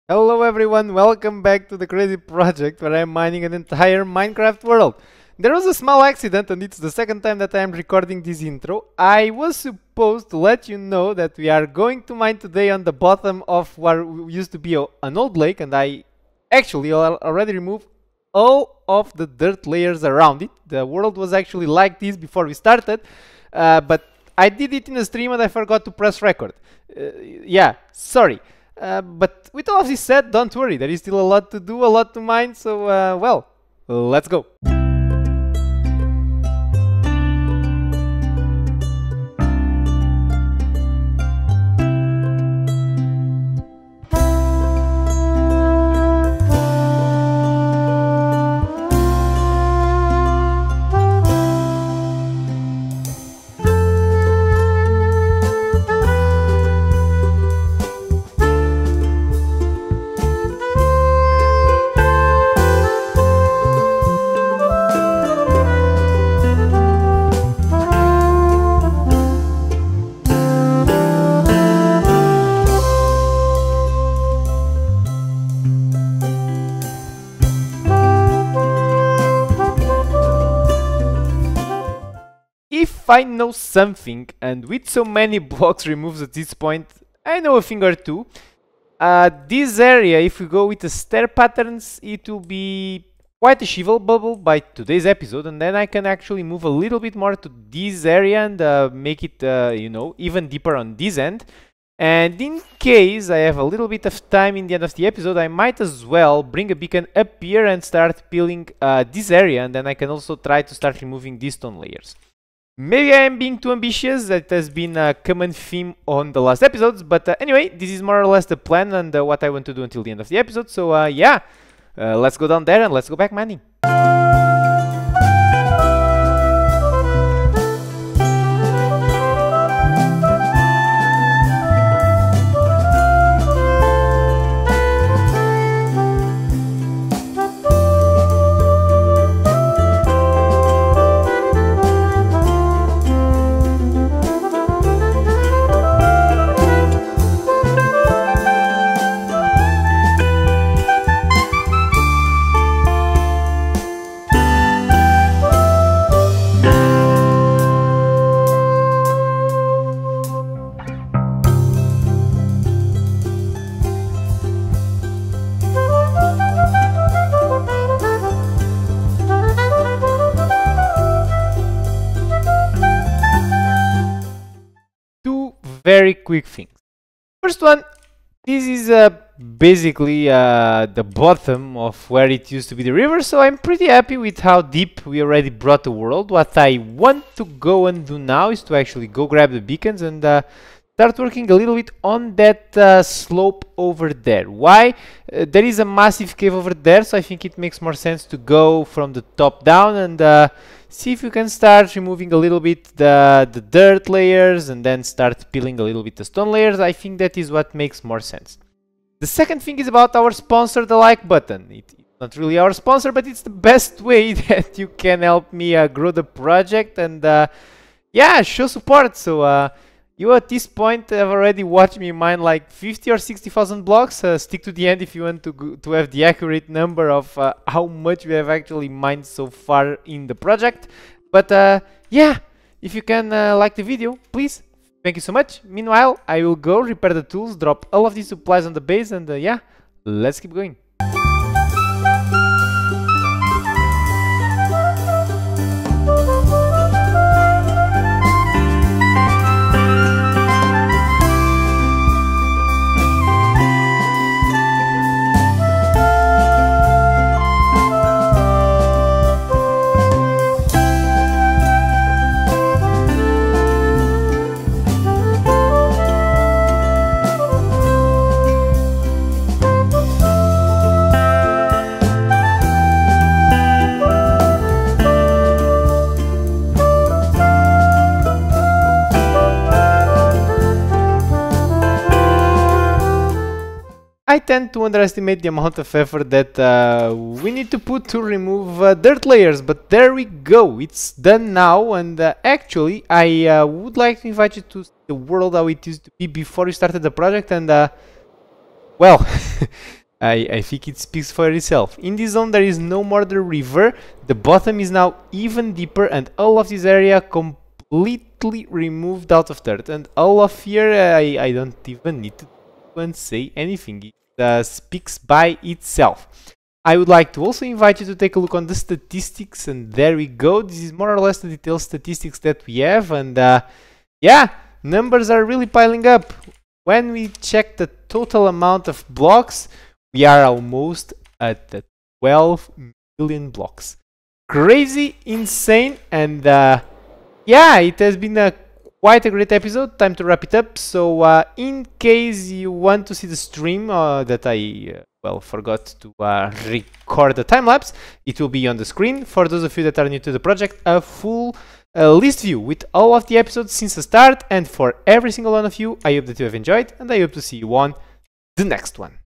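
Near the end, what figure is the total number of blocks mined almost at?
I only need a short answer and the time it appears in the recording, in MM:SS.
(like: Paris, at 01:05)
12 million, at 05:32.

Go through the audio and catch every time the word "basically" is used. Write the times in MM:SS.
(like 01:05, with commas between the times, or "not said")
02:59.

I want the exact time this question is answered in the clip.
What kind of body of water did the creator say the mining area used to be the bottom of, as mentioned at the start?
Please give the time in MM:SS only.
00:15.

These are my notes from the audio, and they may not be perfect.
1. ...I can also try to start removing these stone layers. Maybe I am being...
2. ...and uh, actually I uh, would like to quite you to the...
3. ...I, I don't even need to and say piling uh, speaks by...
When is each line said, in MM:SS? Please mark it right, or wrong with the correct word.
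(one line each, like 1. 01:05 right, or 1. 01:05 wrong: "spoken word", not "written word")
1. 01:49 right
2. 04:51 wrong: "invite", not "quite"
3. 05:10 wrong: "anything", not "piling".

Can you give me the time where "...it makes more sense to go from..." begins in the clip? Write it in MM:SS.
03:17.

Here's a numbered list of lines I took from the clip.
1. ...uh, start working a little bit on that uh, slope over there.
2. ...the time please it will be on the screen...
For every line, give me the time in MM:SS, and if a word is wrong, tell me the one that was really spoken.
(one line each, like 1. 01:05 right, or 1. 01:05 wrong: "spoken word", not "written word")
1. 03:10 right
2. 05:47 wrong: "lapse", not "please".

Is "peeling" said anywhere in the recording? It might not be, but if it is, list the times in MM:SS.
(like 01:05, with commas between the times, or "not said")
01:48, 03:25.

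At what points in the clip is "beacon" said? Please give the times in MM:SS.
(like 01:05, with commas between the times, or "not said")
01:46, 03:09.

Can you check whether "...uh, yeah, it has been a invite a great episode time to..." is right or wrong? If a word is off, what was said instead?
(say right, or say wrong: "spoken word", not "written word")
wrong: "quite", not "invite".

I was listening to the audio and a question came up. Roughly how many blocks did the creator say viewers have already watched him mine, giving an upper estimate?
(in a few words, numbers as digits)
60,000.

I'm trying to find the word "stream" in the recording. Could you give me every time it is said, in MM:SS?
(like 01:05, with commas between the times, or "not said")
00:25, 05:43.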